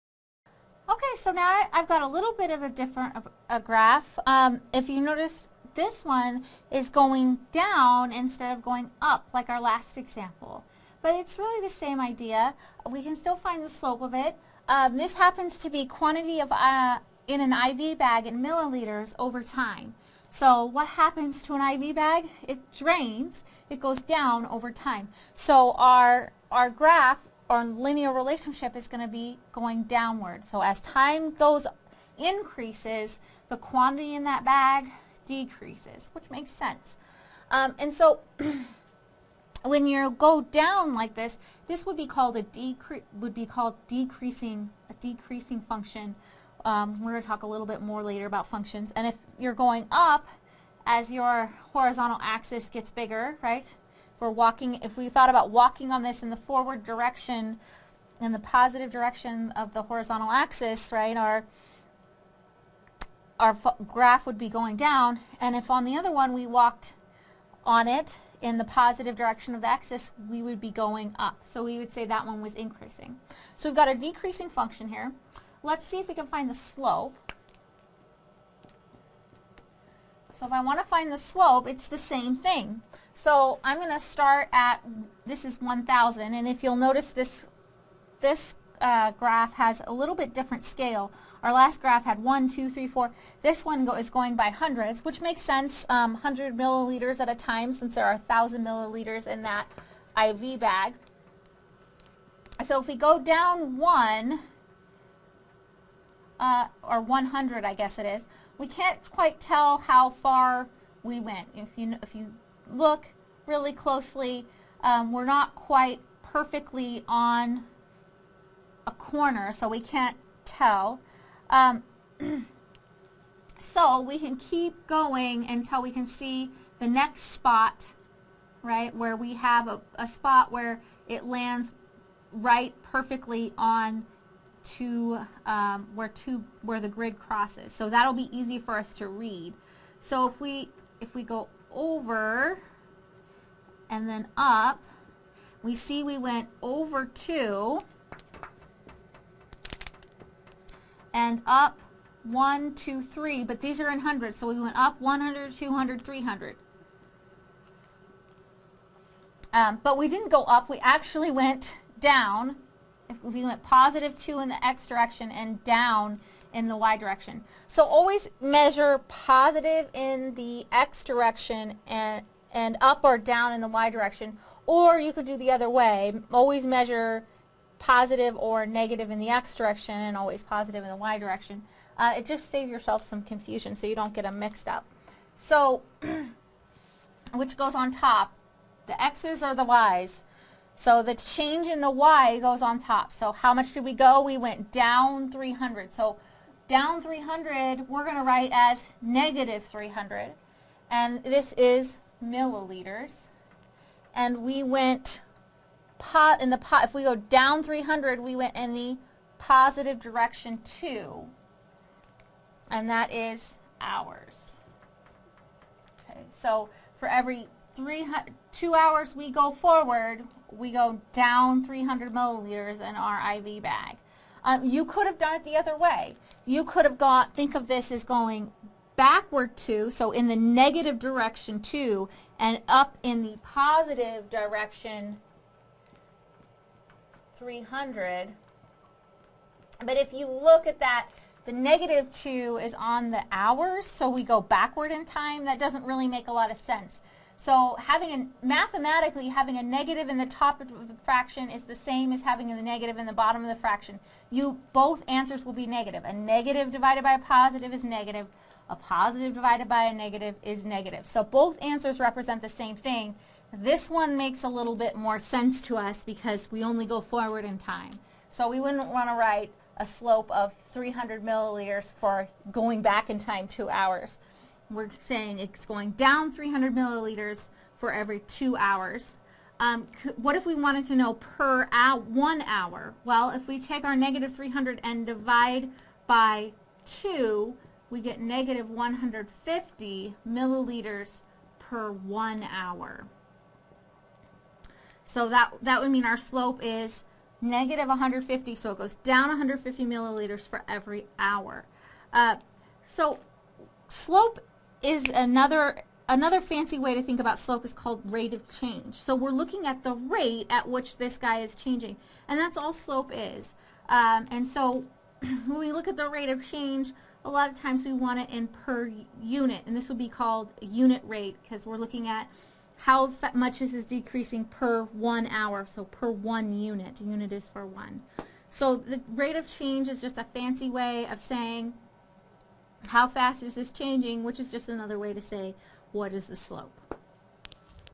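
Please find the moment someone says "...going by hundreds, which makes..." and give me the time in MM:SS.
01:34.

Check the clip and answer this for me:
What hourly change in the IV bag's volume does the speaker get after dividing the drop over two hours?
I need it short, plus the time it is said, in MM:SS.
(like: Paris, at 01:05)
-150 milliliters per hour, at 04:48.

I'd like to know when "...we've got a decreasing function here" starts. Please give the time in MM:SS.
01:13.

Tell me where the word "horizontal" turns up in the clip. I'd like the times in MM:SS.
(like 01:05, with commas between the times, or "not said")
00:51, 00:59.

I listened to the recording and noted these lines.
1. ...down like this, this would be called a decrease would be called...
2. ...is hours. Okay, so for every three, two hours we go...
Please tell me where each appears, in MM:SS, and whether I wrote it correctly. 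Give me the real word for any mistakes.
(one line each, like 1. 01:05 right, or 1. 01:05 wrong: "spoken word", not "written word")
1. 00:40 right
2. 03:33 right.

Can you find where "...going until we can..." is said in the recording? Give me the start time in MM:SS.
02:04.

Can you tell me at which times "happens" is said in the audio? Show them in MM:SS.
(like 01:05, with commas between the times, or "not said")
00:15, 00:20.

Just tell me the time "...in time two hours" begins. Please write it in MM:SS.
04:33.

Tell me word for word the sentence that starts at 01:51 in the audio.
If you, if you look really closely, um, we're not quite perfectly on a corner, so we can't tell.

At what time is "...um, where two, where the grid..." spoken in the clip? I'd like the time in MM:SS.
02:15.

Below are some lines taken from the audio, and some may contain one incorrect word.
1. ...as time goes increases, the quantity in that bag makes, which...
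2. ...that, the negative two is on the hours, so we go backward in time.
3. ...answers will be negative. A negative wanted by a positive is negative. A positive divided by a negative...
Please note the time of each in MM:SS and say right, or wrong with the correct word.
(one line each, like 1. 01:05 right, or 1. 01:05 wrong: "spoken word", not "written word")
1. 00:30 wrong: "decreases", not "makes"
2. 04:00 right
3. 04:15 wrong: "divided", not "wanted".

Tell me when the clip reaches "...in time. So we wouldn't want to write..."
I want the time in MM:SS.
04:27.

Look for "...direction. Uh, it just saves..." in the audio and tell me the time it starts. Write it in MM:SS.
03:01.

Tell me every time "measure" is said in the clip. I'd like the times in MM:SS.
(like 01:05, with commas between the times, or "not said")
02:48, 02:56.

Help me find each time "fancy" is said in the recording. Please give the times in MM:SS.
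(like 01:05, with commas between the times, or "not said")
05:06, 05:30.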